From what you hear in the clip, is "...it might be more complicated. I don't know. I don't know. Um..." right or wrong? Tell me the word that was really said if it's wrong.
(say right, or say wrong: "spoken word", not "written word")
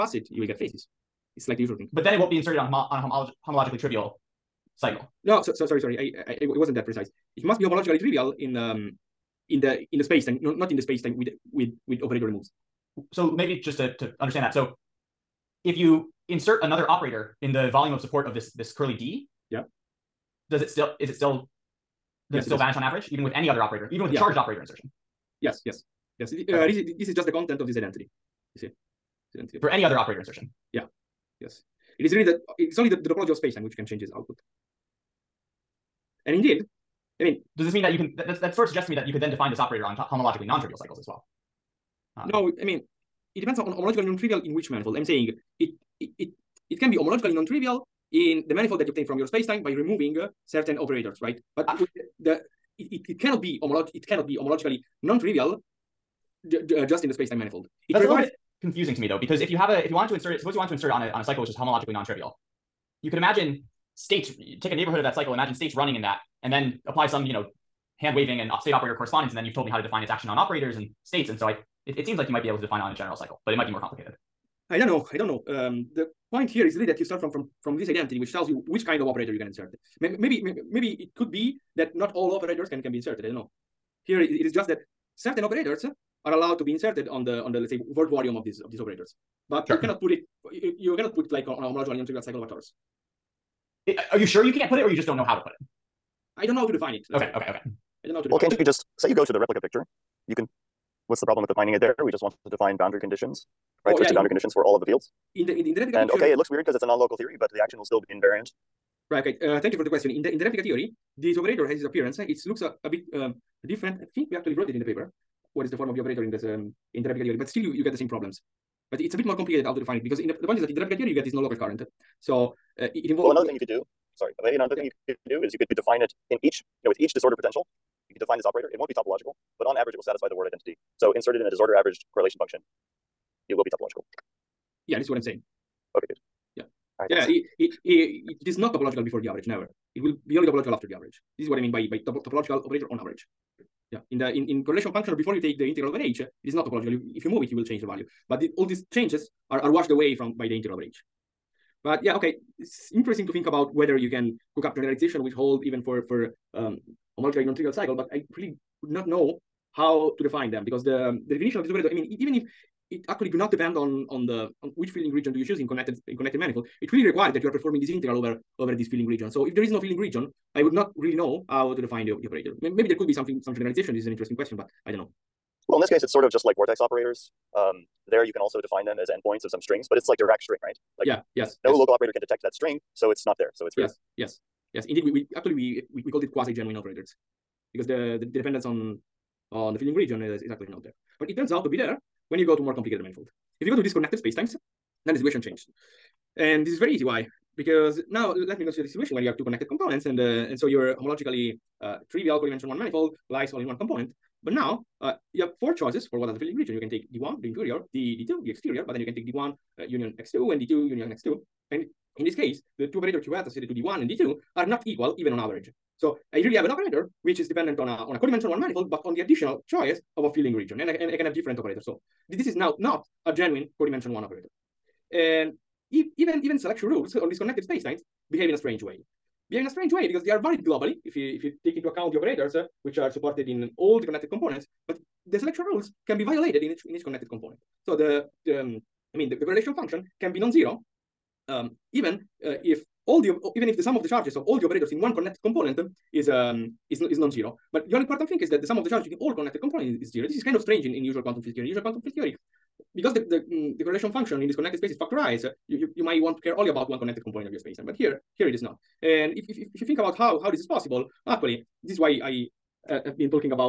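right.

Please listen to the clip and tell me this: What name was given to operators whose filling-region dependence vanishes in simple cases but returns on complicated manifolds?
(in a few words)
quasi genuine operators.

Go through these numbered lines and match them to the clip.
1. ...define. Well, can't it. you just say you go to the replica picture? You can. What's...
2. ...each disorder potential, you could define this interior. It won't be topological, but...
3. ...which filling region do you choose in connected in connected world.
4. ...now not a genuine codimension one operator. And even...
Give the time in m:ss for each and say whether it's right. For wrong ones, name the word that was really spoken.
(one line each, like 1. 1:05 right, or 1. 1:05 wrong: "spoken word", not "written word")
1. 1:38 right
2. 2:06 wrong: "operator", not "interior"
3. 2:44 wrong: "manifold", not "world"
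4. 3:42 right.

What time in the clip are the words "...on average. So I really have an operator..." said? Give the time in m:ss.
3:35.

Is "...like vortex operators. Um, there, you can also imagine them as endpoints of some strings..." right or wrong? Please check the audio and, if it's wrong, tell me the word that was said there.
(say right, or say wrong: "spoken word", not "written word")
wrong: "define", not "imagine".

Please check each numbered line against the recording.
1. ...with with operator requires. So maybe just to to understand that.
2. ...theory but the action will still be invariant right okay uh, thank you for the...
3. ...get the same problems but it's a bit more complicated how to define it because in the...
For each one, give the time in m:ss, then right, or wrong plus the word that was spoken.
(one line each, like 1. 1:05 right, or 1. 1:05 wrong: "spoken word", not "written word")
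1. 0:11 wrong: "removes", not "requires"
2. 1:47 right
3. 1:57 right.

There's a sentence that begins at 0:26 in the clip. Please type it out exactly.
Uh, This is just the content of this identity.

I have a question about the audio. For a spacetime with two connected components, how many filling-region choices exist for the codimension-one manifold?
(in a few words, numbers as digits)
4.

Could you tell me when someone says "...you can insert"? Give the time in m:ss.
1:19.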